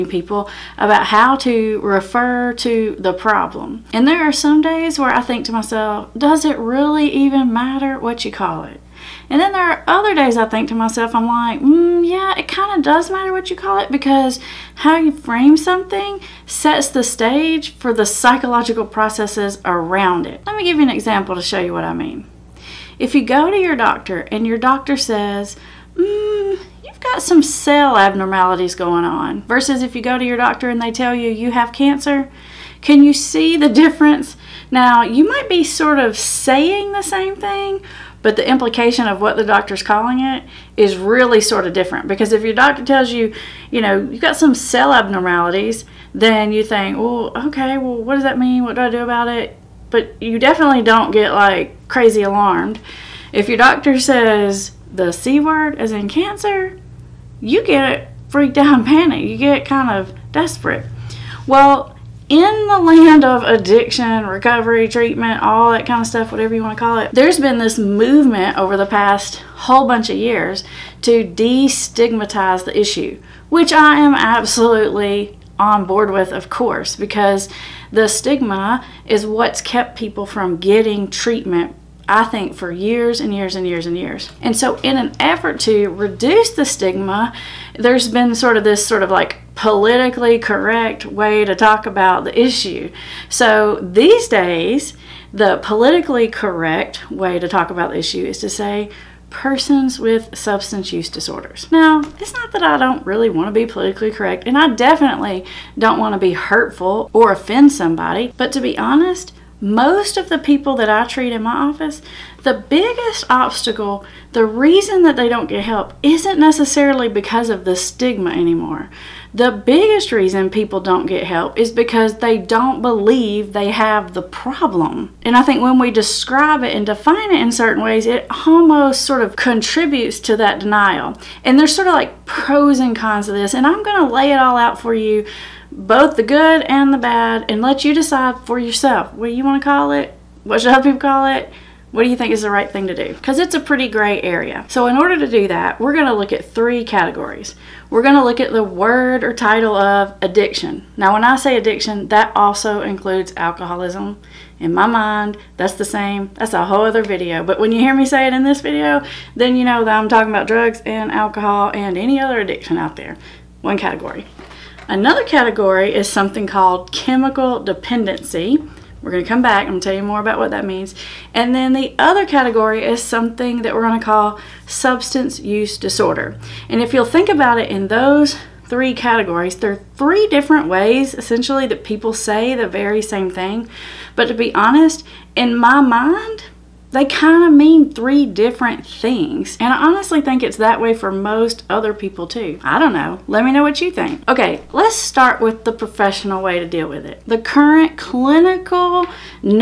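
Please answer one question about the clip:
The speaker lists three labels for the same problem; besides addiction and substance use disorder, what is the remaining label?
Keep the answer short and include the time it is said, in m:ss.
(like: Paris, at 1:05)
chemical dependency, at 2:46.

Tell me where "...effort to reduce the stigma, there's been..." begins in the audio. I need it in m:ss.
1:25.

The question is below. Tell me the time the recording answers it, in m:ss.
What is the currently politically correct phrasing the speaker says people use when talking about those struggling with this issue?
1:39.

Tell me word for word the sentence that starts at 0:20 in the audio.
Let me give you an example to show you what I mean.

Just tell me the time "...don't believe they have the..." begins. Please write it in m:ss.
2:02.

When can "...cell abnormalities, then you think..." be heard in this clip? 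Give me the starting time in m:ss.
0:44.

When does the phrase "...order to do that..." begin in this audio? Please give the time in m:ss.
2:24.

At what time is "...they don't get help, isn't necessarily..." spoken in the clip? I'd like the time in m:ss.
1:55.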